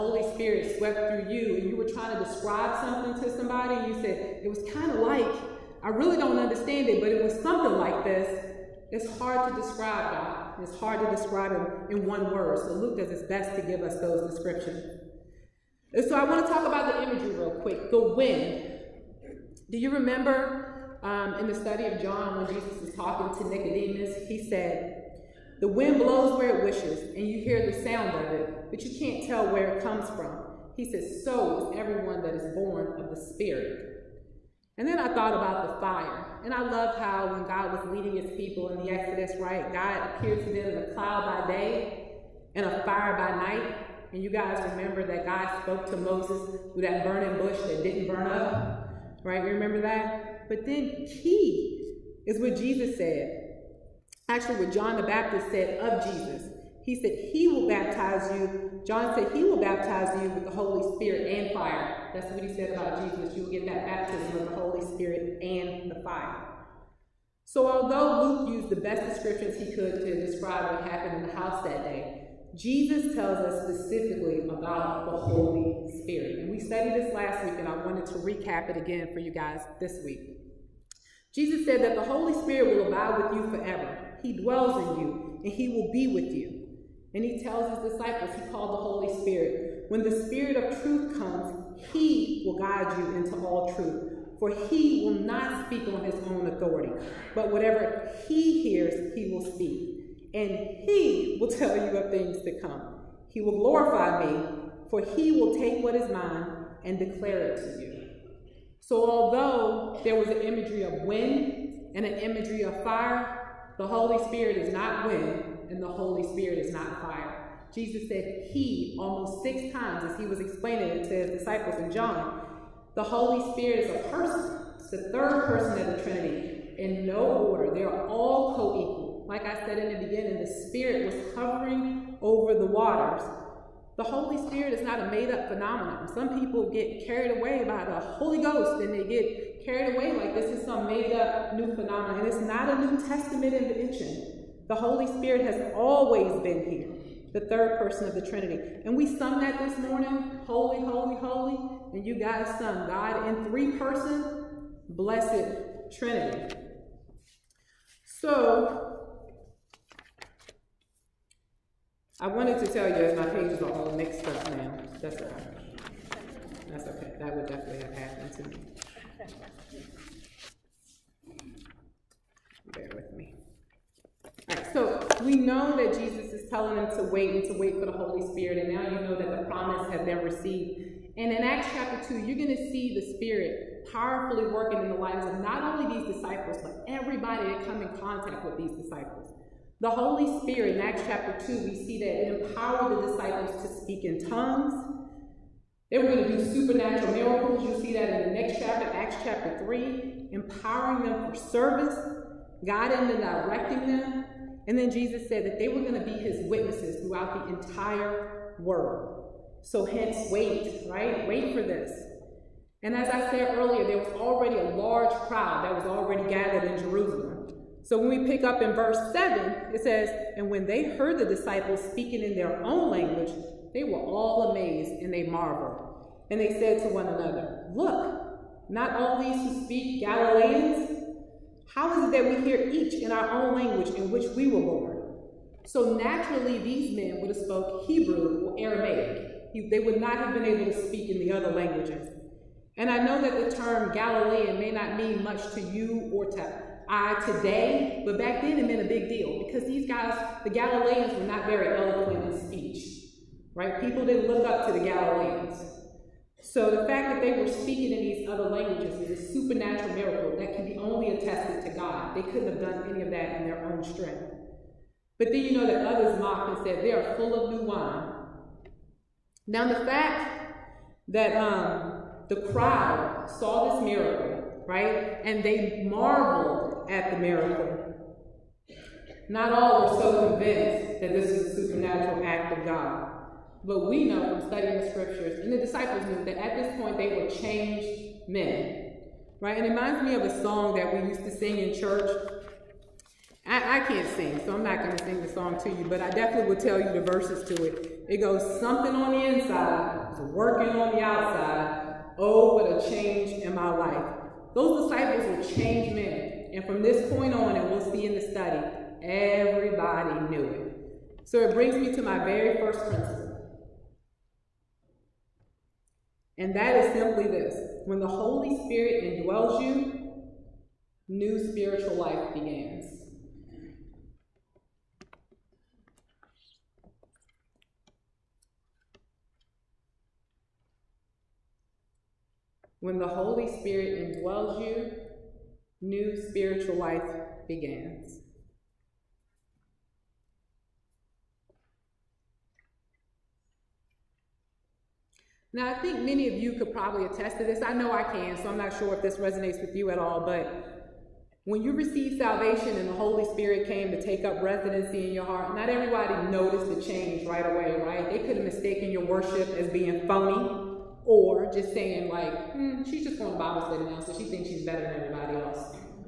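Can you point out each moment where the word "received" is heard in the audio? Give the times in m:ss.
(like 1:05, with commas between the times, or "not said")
3:00, 5:51.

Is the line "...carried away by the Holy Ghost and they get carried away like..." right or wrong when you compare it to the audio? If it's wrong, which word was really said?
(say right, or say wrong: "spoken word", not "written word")
right.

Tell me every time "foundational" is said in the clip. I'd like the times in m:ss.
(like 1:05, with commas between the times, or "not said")
not said.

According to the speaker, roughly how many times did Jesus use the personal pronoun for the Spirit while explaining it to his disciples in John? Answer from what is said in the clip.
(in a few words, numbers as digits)
6.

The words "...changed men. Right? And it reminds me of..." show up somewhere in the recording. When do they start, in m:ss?
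4:47.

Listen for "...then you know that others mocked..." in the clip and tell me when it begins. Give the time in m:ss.
4:25.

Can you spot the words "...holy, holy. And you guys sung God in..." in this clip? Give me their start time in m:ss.
2:30.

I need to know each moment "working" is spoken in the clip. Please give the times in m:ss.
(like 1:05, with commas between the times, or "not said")
3:04, 5:00.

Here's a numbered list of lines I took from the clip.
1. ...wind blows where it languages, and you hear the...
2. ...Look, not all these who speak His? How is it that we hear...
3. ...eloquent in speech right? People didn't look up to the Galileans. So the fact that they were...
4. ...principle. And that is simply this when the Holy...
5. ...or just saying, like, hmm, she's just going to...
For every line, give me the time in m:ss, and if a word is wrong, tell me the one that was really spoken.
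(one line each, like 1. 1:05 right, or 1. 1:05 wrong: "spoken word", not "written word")
1. 0:25 wrong: "wishes", not "languages"
2. 3:47 wrong: "Galileans", not "His"
3. 4:11 right
4. 5:12 right
5. 6:01 right.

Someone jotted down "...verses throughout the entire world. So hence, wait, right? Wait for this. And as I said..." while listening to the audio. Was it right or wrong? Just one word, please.
wrong.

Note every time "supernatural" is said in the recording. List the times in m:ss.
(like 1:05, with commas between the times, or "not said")
3:16, 4:19, 4:41.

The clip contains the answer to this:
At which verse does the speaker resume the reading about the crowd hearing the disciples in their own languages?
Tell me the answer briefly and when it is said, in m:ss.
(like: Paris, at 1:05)
7, at 3:38.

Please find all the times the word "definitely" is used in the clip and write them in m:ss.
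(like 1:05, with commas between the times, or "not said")
2:47, 4:56.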